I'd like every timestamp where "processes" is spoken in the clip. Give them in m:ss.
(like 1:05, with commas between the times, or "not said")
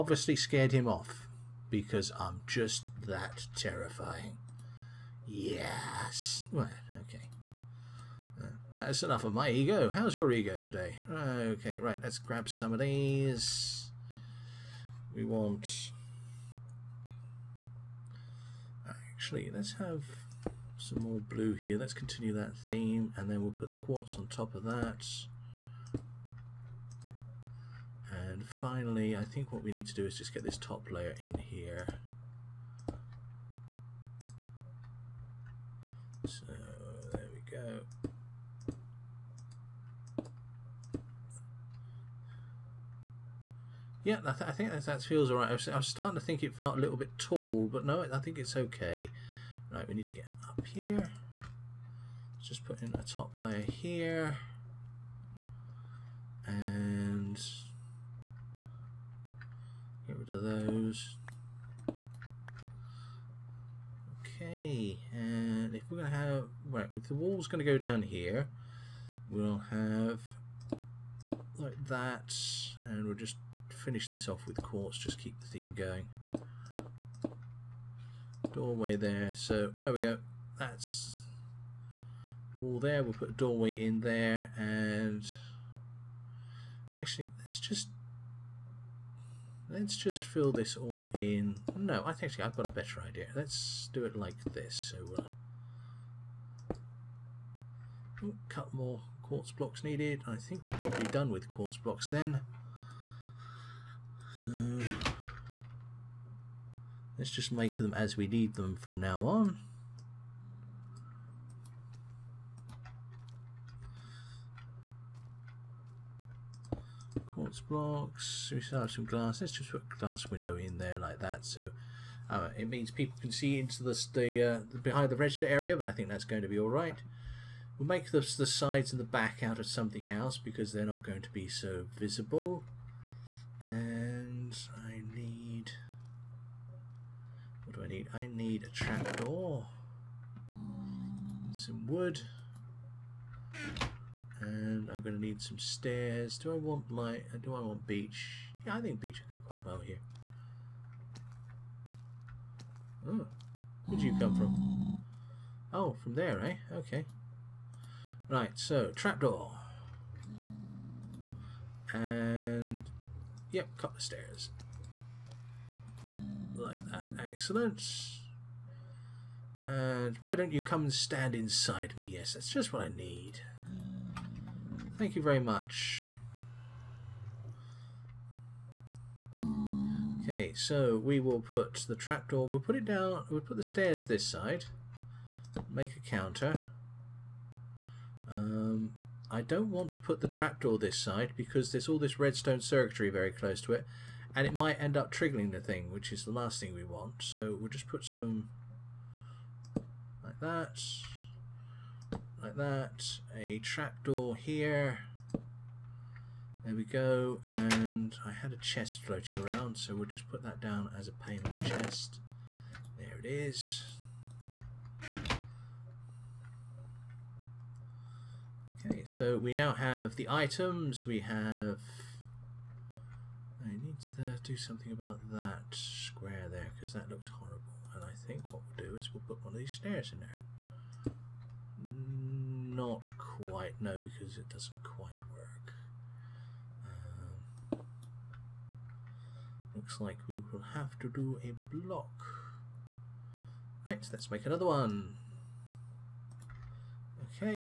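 not said.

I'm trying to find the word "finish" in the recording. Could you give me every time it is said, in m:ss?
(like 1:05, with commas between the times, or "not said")
1:13.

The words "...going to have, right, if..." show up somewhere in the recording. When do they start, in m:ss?
1:05.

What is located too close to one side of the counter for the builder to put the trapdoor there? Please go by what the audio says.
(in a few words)
Redstone circuitry.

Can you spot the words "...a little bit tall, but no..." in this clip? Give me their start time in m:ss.
0:46.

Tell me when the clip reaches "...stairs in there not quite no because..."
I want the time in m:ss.
3:49.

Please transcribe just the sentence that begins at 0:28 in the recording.
finally, I think what we need to do is just get this top layer in here.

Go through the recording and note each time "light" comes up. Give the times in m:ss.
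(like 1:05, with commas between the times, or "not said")
2:26.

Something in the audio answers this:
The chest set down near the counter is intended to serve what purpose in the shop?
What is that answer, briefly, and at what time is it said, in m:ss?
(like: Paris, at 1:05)
Payment chest, at 3:31.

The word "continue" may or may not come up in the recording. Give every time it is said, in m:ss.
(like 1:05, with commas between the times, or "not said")
0:21.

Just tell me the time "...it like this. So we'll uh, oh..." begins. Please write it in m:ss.
1:34.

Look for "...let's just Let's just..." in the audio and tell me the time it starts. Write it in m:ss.
1:27.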